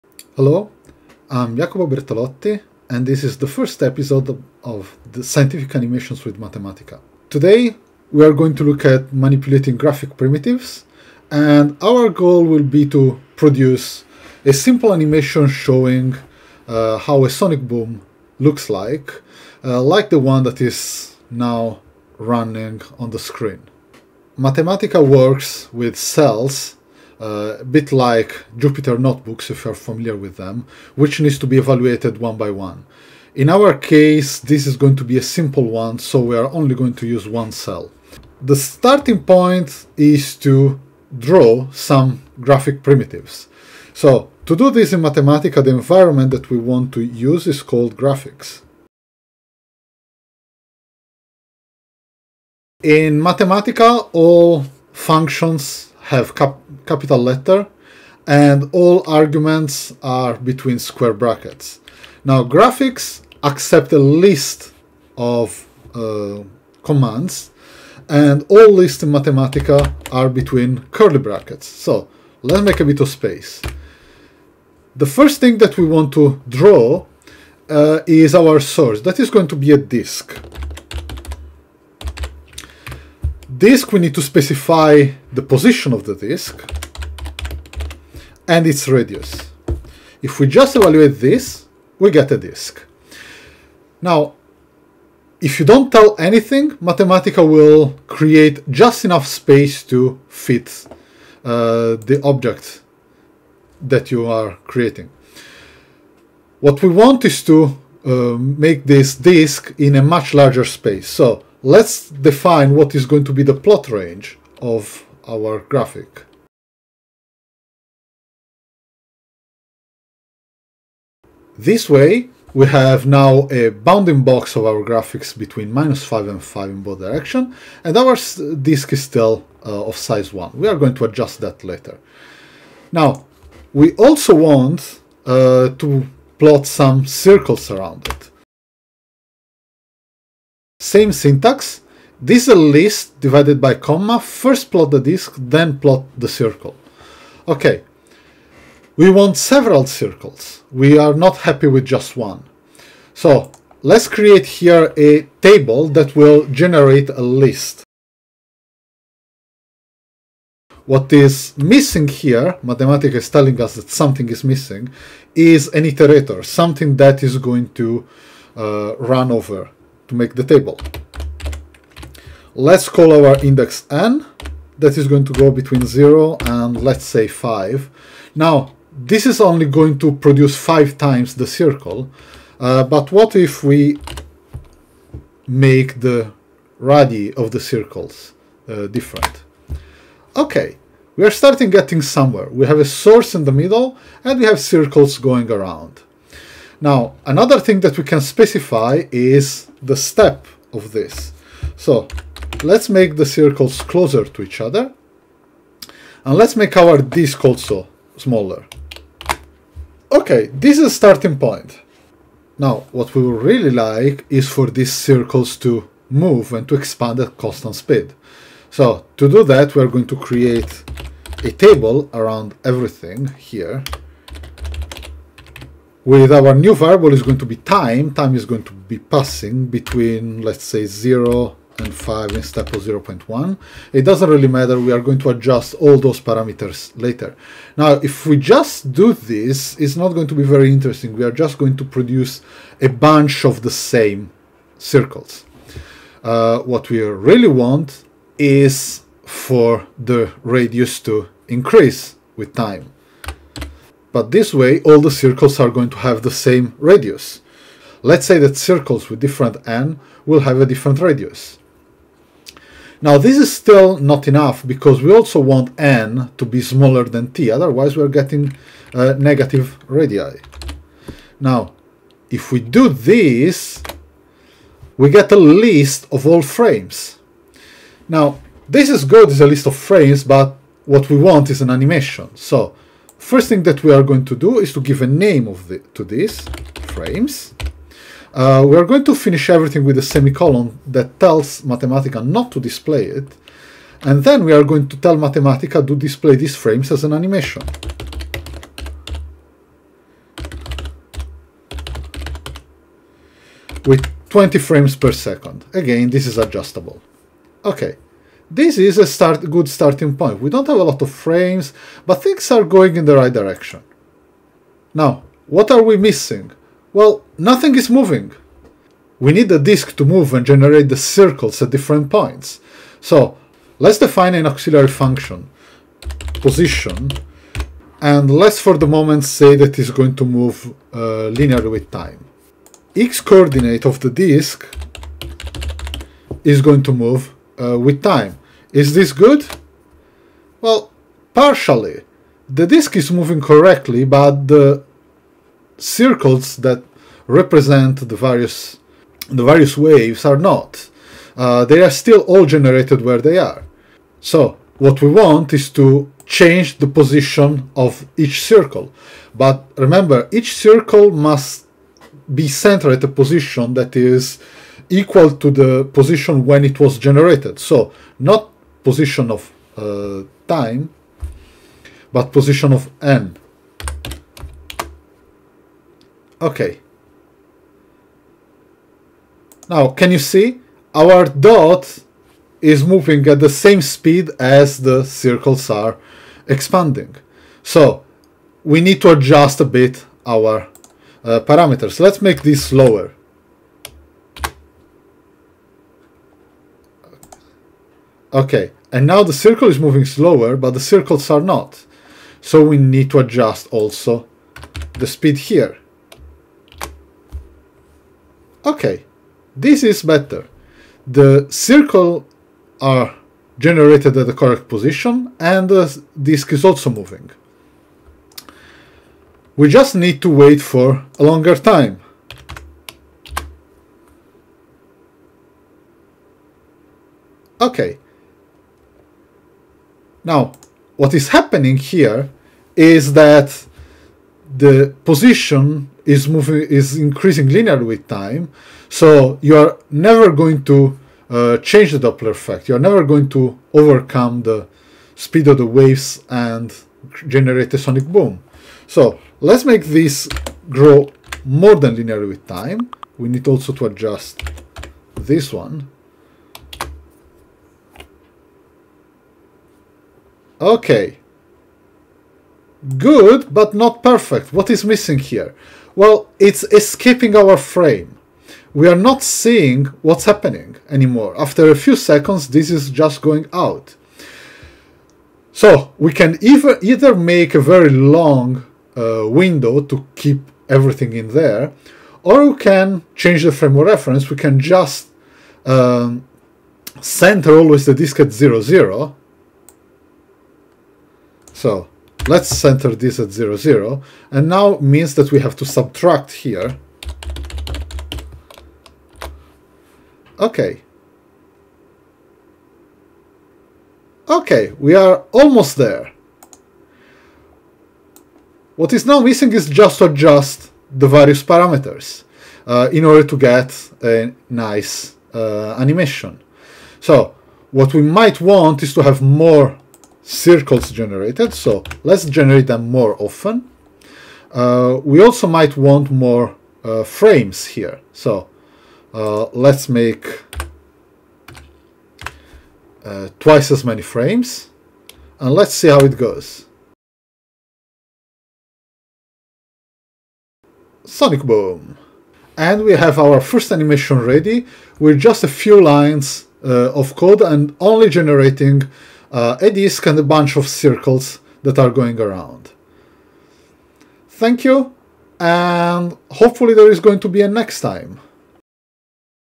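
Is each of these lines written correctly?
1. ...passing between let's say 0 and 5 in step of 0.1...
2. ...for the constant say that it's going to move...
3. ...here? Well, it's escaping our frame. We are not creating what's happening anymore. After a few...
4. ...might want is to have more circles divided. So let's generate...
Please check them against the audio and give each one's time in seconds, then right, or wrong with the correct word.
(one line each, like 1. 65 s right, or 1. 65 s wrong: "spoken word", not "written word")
1. 228 s right
2. 328 s wrong: "moment", not "constant"
3. 465 s wrong: "seeing", not "creating"
4. 518 s wrong: "generated", not "divided".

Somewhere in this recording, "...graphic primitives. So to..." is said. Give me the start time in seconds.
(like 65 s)
42 s.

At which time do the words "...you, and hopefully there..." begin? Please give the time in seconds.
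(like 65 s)
554 s.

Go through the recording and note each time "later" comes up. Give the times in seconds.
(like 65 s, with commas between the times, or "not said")
131 s, 236 s.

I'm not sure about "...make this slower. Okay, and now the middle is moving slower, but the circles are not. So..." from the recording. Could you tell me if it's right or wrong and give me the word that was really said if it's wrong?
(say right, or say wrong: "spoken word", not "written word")
wrong: "circle", not "middle".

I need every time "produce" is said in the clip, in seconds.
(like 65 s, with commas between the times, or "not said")
13 s, 180 s, 241 s.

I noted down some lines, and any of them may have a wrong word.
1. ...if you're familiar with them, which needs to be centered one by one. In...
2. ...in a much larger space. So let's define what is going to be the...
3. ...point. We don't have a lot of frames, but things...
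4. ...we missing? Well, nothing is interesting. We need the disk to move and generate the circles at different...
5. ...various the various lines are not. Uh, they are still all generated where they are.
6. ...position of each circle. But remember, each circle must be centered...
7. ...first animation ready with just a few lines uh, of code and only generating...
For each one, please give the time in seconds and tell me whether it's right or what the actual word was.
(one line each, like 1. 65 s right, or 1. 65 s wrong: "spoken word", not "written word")
1. 29 s wrong: "evaluated", not "centered"
2. 109 s right
3. 310 s right
4. 315 s wrong: "moving", not "interesting"
5. 348 s wrong: "waves", not "lines"
6. 356 s right
7. 543 s right.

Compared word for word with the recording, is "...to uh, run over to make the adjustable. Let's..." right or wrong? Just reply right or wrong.
wrong.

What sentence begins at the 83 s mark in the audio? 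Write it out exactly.
Disk we need to specify the position of the disk and its radius.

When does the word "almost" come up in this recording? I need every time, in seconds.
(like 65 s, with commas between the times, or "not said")
505 s.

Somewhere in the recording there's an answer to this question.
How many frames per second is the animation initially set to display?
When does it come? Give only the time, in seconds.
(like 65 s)
304 s.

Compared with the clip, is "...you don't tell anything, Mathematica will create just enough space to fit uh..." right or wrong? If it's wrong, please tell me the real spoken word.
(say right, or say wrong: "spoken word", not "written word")
right.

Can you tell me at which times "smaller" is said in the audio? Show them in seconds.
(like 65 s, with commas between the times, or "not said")
208 s, 266 s.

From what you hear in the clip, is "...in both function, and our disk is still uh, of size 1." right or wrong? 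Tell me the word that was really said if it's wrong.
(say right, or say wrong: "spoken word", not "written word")
wrong: "direction", not "function".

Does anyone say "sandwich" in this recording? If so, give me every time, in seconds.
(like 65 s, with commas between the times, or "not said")
not said.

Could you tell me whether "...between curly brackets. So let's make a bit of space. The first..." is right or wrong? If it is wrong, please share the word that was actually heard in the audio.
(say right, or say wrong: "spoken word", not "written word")
right.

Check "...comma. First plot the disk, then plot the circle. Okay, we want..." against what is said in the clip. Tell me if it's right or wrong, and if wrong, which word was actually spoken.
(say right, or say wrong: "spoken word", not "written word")
right.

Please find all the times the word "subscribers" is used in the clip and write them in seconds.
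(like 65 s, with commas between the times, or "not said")
not said.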